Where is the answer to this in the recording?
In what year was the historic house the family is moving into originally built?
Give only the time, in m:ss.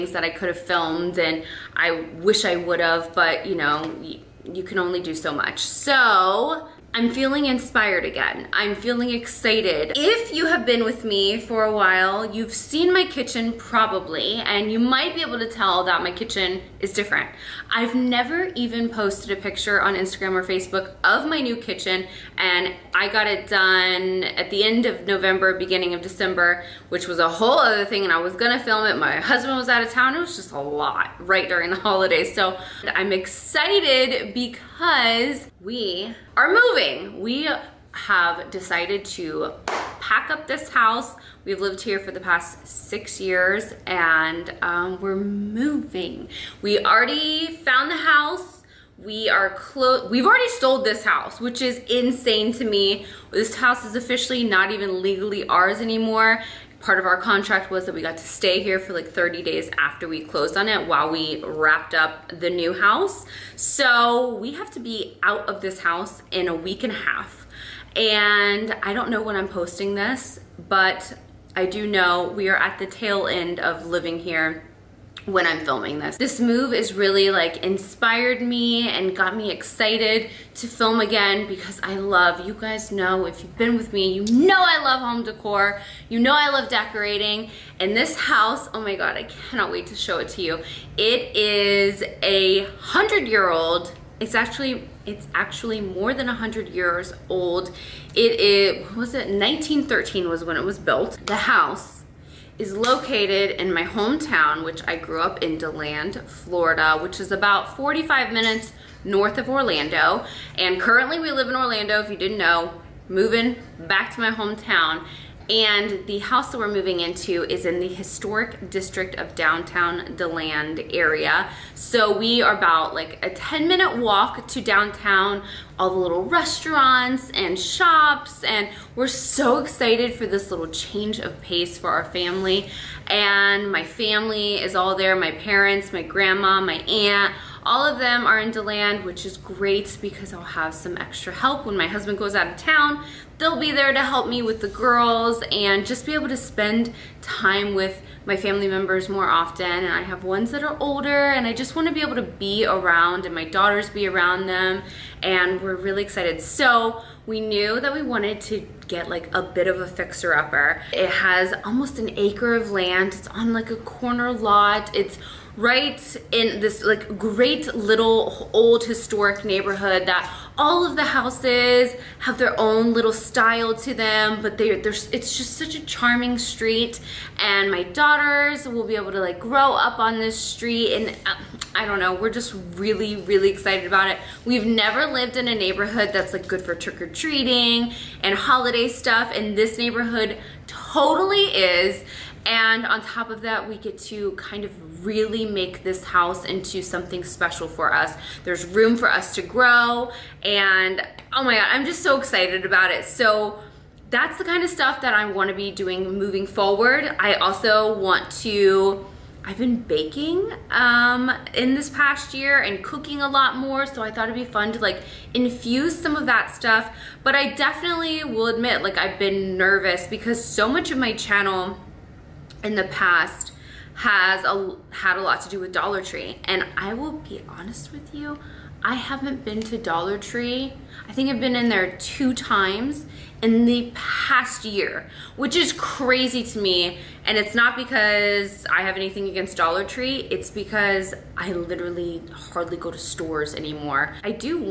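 1:39.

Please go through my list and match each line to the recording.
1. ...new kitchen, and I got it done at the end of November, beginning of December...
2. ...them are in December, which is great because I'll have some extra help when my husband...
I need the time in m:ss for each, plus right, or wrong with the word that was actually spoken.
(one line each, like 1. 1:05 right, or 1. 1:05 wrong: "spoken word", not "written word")
1. 0:21 right
2. 2:17 wrong: "DeLand", not "December".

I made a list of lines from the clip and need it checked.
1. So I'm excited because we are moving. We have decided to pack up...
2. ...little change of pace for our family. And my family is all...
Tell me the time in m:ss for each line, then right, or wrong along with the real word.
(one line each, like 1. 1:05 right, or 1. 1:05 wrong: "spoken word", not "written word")
1. 0:32 right
2. 2:10 right.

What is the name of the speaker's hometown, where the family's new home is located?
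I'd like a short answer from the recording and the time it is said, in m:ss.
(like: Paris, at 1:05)
DeLand, Florida, at 1:45.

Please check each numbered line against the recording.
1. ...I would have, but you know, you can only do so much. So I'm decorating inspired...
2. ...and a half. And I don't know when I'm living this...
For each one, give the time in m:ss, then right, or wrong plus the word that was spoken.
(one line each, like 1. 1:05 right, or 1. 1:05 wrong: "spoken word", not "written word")
1. 0:02 wrong: "feeling", not "decorating"
2. 1:06 wrong: "posting", not "living".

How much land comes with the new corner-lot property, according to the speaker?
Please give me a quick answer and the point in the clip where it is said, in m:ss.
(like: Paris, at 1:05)
Almost an acre, at 2:41.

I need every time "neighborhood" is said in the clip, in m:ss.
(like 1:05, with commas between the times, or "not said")
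2:49, 3:05, 3:09.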